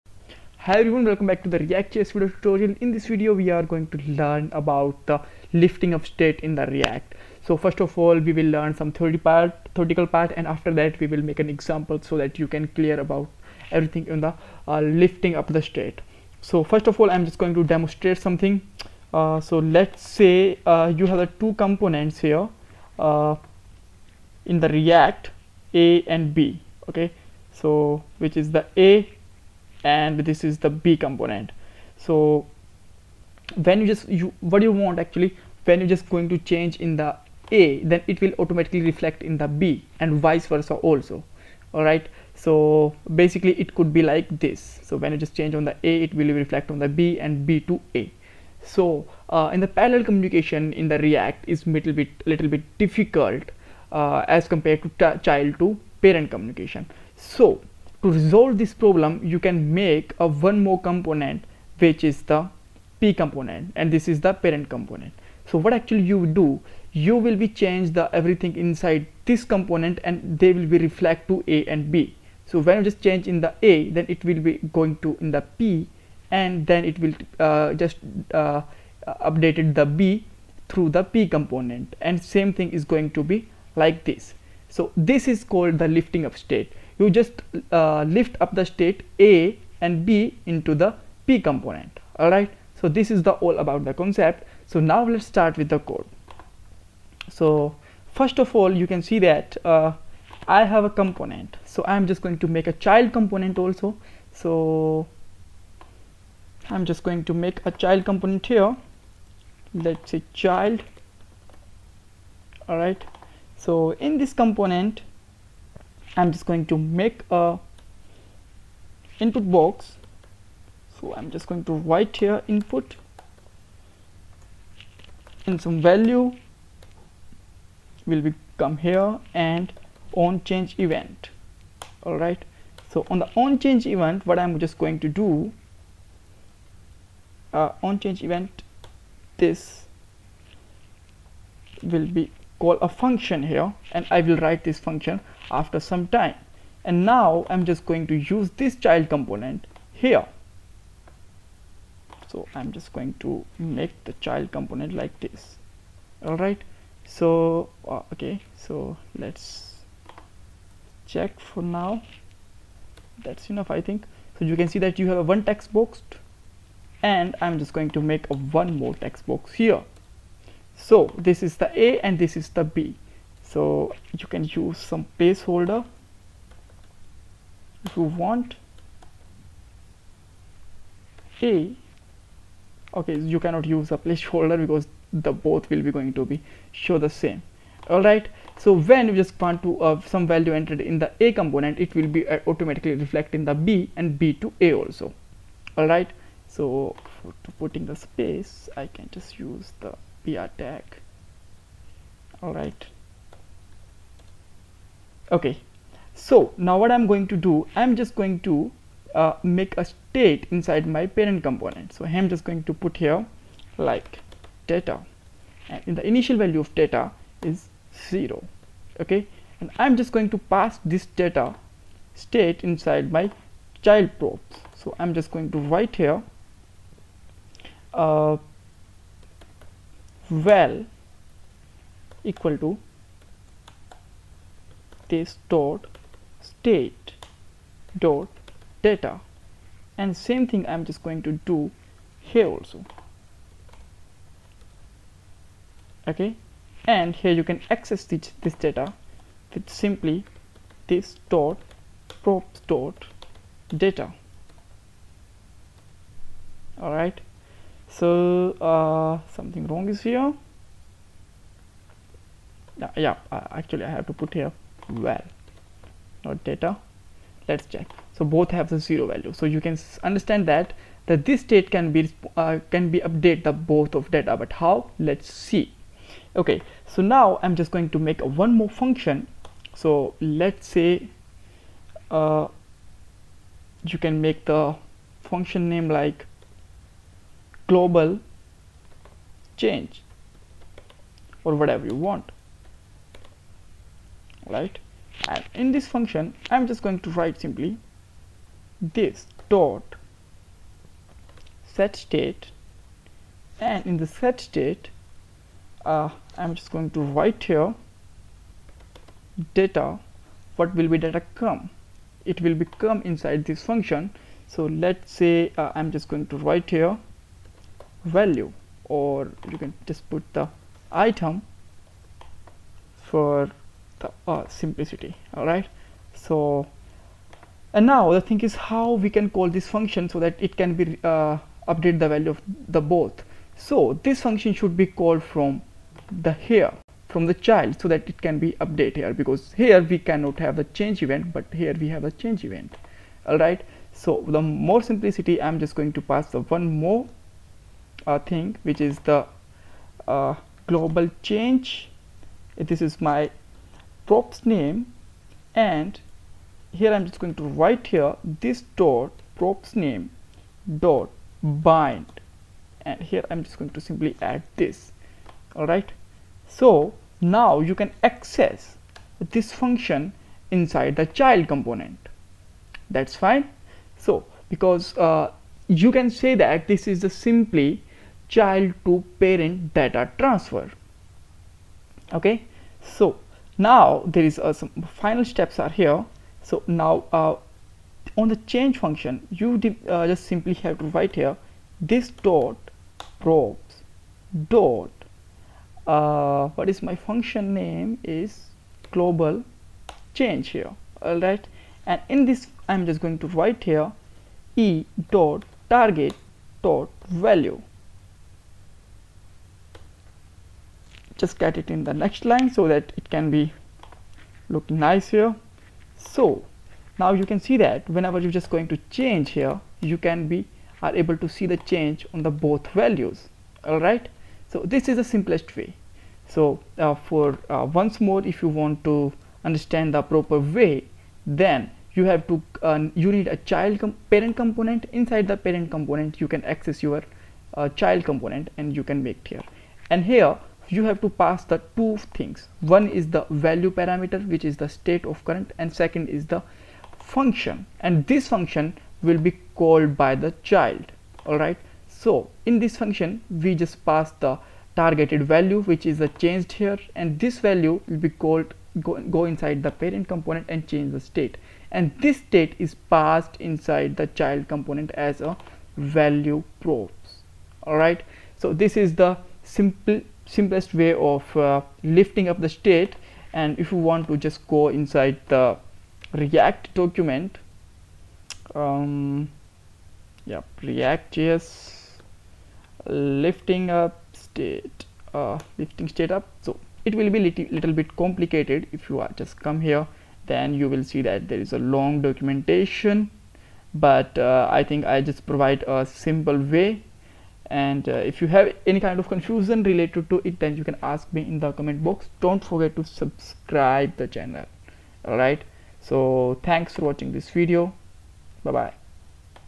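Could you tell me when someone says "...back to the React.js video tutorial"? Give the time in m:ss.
0:01.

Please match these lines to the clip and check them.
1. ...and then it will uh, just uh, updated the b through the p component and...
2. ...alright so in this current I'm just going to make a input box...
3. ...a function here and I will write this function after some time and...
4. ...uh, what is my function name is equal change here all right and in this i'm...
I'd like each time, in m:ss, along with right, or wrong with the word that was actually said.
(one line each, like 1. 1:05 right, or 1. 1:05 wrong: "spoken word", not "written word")
1. 1:16 right
2. 1:52 wrong: "component", not "current"
3. 2:22 right
4. 6:35 wrong: "global", not "equal".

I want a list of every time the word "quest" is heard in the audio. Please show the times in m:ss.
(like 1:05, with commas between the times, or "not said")
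not said.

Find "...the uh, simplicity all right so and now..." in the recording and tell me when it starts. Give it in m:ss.
5:23.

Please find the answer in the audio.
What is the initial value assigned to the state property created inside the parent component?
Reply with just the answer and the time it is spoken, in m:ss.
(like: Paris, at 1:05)
0, at 3:38.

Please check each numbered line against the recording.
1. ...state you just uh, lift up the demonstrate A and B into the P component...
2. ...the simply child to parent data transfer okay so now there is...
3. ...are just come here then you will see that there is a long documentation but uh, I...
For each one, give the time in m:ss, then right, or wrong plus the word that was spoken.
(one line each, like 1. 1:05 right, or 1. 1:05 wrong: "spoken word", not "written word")
1. 1:26 wrong: "state", not "demonstrate"
2. 6:17 right
3. 8:08 right.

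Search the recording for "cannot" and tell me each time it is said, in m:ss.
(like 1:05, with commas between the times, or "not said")
3:03, 5:39.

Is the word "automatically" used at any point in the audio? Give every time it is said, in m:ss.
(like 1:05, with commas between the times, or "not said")
0:38, 3:12.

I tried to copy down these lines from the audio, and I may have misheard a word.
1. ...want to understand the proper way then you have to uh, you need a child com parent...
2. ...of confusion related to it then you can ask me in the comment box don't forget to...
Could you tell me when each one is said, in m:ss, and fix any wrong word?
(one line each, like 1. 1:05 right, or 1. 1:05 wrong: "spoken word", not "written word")
1. 7:08 right
2. 8:18 right.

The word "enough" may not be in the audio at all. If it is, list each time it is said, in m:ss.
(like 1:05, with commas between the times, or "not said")
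2:43.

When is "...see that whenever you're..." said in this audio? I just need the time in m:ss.
6:57.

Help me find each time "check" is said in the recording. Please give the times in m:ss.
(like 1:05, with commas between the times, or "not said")
2:41, 4:27.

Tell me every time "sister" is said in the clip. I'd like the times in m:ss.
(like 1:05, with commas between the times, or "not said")
not said.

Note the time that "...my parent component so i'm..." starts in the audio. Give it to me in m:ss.
3:30.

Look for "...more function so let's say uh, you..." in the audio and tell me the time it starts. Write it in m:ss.
4:38.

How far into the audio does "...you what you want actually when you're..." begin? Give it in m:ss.
0:34.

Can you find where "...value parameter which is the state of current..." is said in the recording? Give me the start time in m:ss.
7:23.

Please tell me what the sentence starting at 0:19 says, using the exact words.
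Uh, so let's say uh, you have the two components here uh, in the React, A and B, okay?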